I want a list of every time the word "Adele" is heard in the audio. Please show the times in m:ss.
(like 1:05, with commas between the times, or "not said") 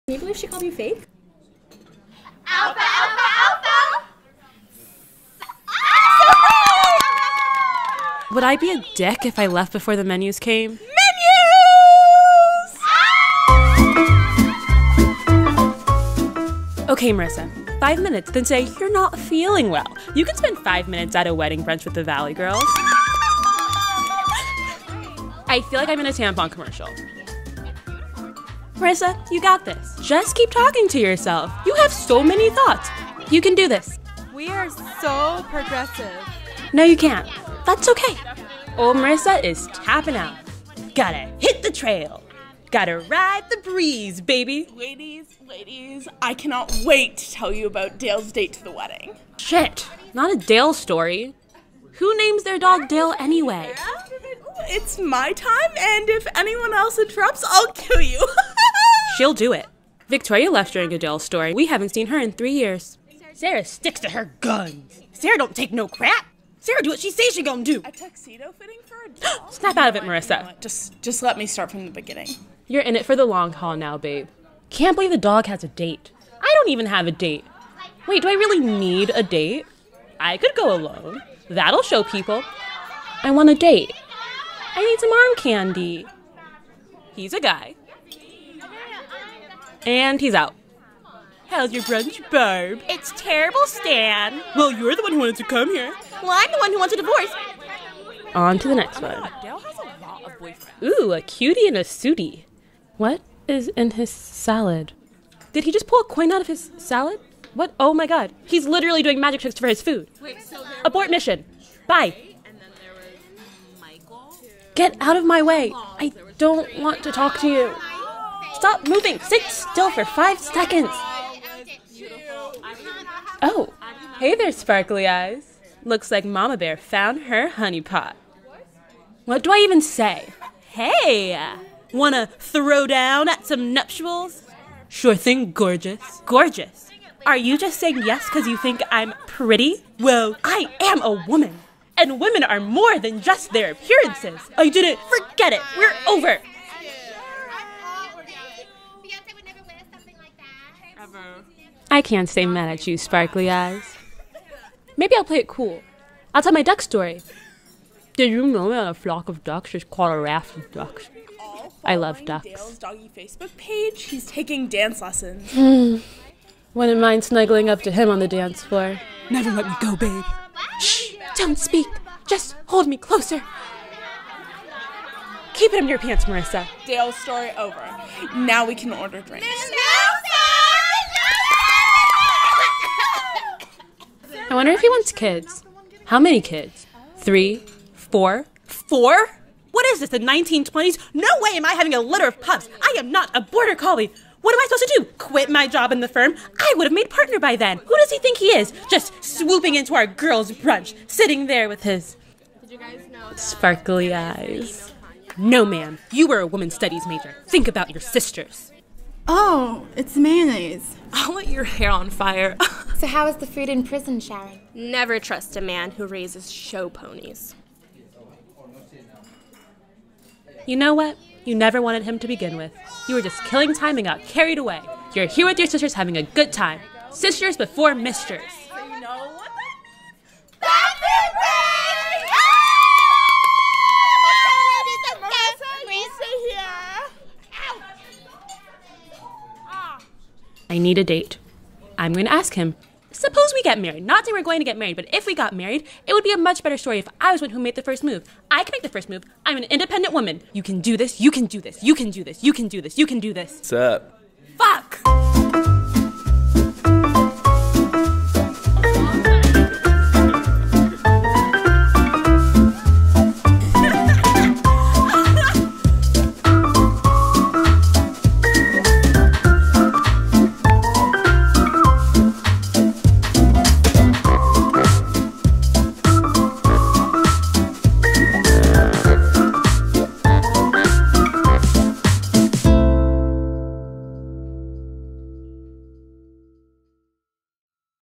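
1:00, 1:09.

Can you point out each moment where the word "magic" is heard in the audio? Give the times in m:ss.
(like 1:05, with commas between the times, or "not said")
1:49.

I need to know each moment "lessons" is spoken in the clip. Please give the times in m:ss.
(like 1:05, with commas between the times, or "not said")
2:45.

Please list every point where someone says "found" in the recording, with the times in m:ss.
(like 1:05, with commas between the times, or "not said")
2:06.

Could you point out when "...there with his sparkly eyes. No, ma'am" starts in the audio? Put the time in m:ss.
3:21.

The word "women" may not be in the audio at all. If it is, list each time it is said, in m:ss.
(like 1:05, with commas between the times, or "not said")
2:22, 3:26.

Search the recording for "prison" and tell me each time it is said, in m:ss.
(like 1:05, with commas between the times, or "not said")
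3:33.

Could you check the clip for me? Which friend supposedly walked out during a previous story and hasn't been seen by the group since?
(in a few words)
Victoria.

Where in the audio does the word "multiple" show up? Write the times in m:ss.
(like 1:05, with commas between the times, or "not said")
not said.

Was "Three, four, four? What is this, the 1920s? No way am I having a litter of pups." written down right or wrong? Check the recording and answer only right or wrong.
right.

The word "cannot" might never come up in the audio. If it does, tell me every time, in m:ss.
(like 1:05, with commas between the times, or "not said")
0:46.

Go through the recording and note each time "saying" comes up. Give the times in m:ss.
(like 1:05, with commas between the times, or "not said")
2:17, 4:04.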